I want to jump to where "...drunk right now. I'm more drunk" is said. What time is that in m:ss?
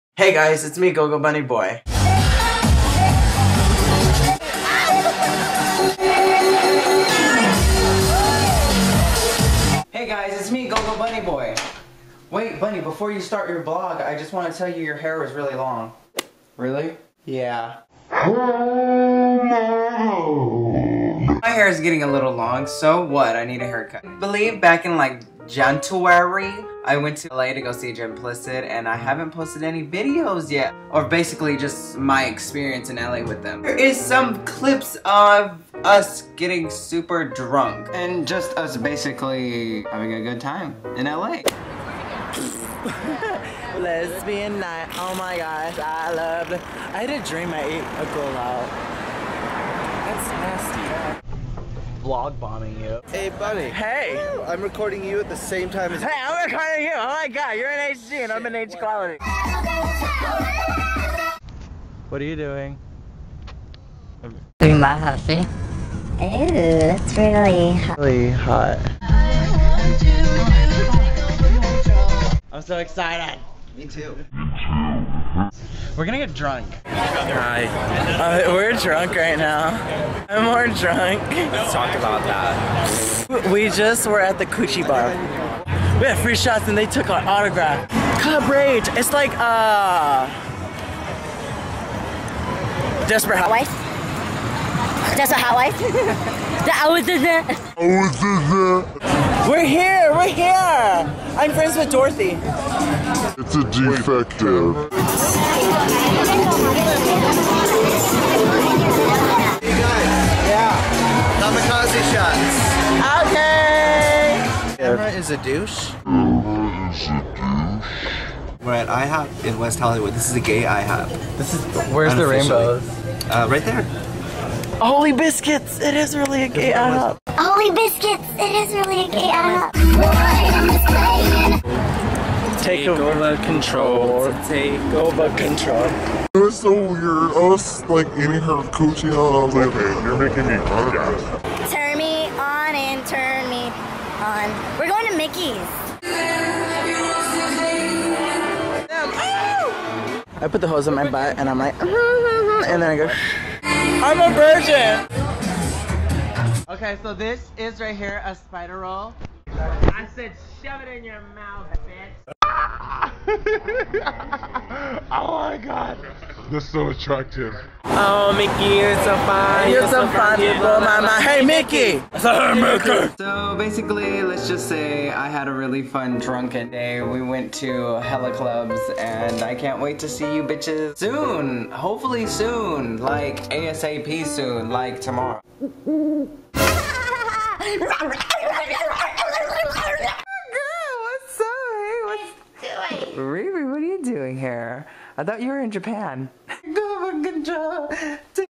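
1:18.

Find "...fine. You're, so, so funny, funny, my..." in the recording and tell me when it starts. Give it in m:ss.
2:49.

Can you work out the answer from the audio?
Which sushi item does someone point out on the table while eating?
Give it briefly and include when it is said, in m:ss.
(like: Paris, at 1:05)
Spider roll, at 2:38.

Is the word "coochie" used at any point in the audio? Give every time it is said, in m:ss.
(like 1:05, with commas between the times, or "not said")
1:24, 2:18.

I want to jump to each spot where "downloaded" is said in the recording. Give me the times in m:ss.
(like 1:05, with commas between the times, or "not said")
not said.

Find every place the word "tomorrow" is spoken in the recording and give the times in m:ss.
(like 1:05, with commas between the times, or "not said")
3:04.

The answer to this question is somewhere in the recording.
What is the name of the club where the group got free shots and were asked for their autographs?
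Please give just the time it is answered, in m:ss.
1:28.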